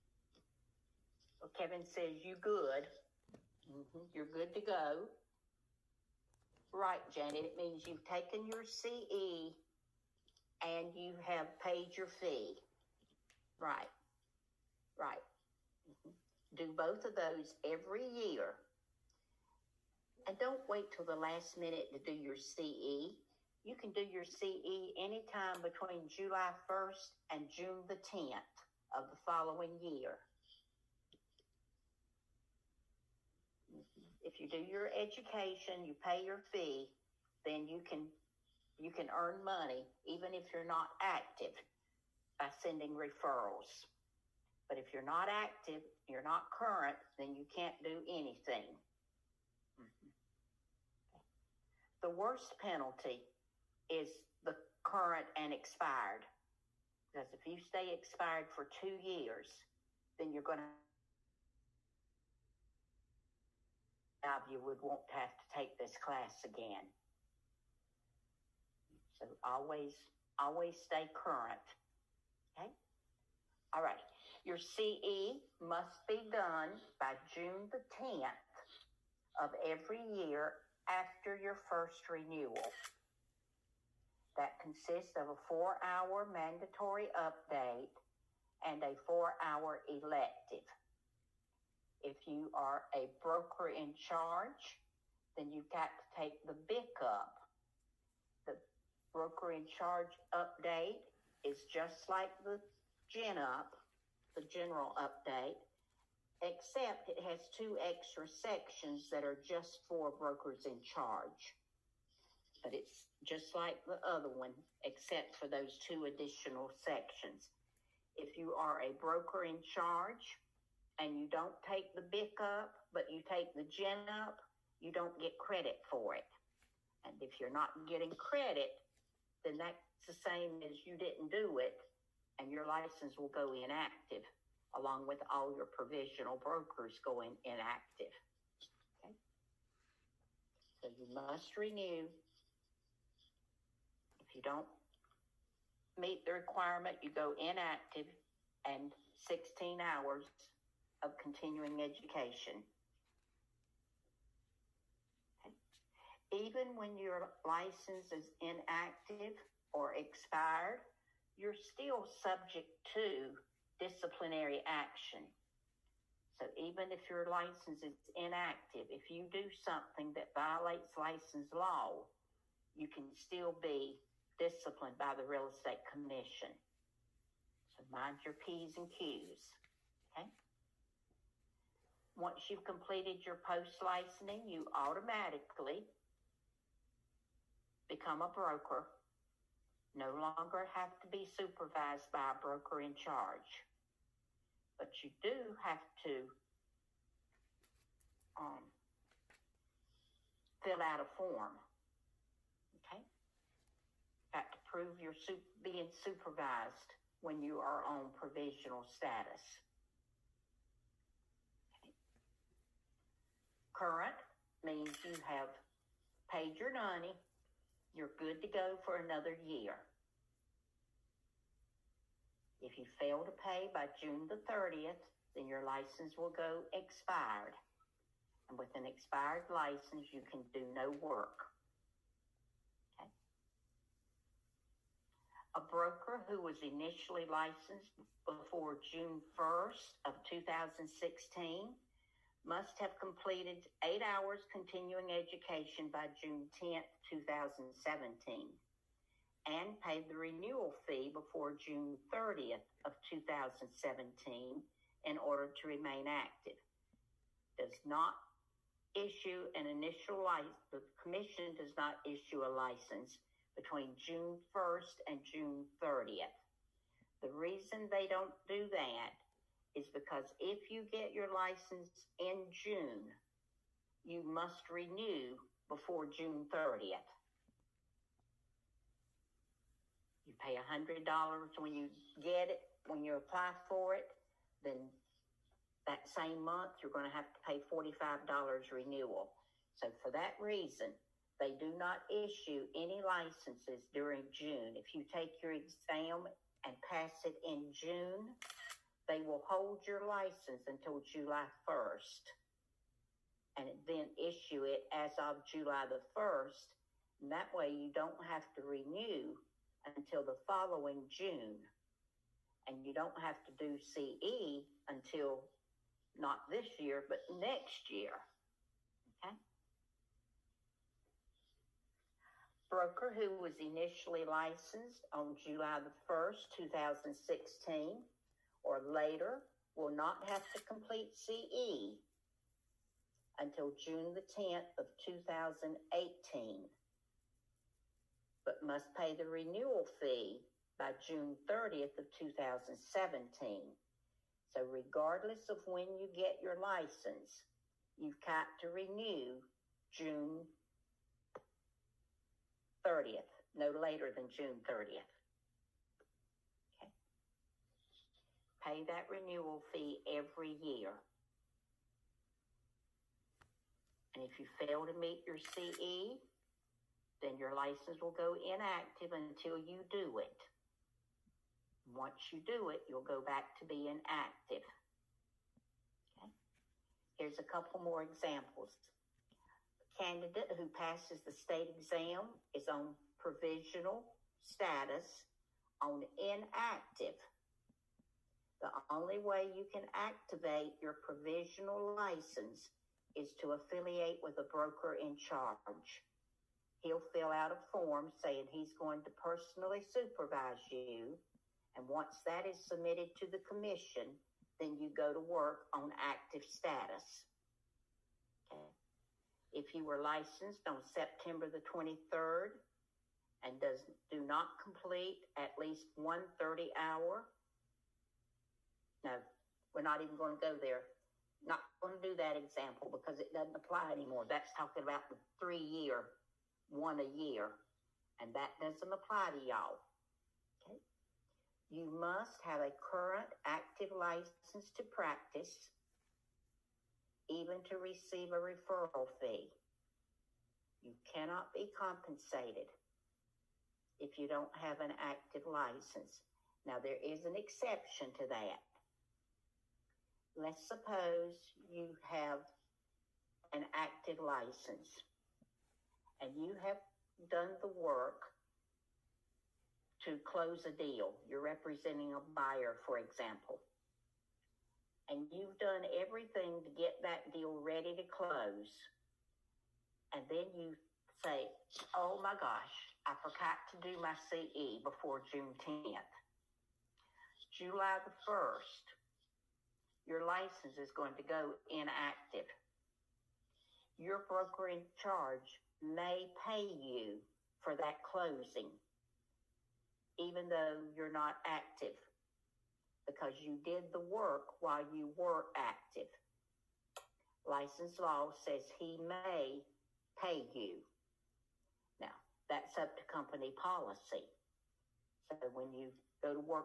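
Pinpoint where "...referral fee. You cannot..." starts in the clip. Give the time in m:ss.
7:18.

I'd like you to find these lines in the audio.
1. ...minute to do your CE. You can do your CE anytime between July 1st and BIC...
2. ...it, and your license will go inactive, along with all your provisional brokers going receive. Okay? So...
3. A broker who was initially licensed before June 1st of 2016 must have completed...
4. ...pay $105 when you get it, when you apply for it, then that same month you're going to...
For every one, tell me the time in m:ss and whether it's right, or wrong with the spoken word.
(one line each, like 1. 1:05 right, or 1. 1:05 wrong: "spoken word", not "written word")
1. 0:21 wrong: "June", not "BIC"
2. 2:11 wrong: "inactive", not "receive"
3. 3:55 right
4. 4:40 wrong: "100", not "105".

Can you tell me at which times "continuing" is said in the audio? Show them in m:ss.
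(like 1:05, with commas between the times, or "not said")
2:31, 4:04.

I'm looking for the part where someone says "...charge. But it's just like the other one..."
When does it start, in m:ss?
1:50.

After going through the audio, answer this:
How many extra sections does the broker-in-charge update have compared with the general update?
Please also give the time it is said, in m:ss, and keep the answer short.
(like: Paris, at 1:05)
2, at 1:47.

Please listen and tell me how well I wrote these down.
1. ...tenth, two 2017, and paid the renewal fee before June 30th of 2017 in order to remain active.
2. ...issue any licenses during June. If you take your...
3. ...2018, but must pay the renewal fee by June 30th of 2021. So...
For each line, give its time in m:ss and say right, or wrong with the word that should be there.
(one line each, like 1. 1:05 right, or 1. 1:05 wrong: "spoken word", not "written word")
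1. 4:06 right
2. 4:52 right
3. 5:34 wrong: "2017", not "2021".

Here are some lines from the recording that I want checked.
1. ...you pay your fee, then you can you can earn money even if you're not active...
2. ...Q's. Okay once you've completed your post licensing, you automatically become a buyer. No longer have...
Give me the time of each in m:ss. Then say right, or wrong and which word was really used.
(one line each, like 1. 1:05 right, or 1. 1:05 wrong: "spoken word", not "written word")
1. 0:35 right
2. 2:58 wrong: "broker", not "buyer".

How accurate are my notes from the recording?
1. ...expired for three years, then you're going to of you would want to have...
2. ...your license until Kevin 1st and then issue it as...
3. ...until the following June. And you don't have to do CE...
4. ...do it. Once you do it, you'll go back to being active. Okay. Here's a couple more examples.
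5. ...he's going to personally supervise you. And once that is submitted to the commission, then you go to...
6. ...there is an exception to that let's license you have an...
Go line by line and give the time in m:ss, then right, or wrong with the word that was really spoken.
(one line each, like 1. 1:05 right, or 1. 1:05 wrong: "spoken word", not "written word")
1. 0:57 wrong: "two", not "three"
2. 4:59 wrong: "July", not "Kevin"
3. 5:09 right
4. 6:09 right
5. 6:38 right
6. 7:26 wrong: "suppose", not "license".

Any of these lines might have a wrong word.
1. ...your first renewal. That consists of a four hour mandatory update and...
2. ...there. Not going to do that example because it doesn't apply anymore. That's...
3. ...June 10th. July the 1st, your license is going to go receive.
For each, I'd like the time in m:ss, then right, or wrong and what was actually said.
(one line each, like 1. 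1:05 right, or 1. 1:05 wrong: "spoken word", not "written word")
1. 1:21 right
2. 7:00 right
3. 7:55 wrong: "inactive", not "receive".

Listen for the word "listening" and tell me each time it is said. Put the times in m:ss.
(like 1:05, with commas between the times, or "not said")
not said.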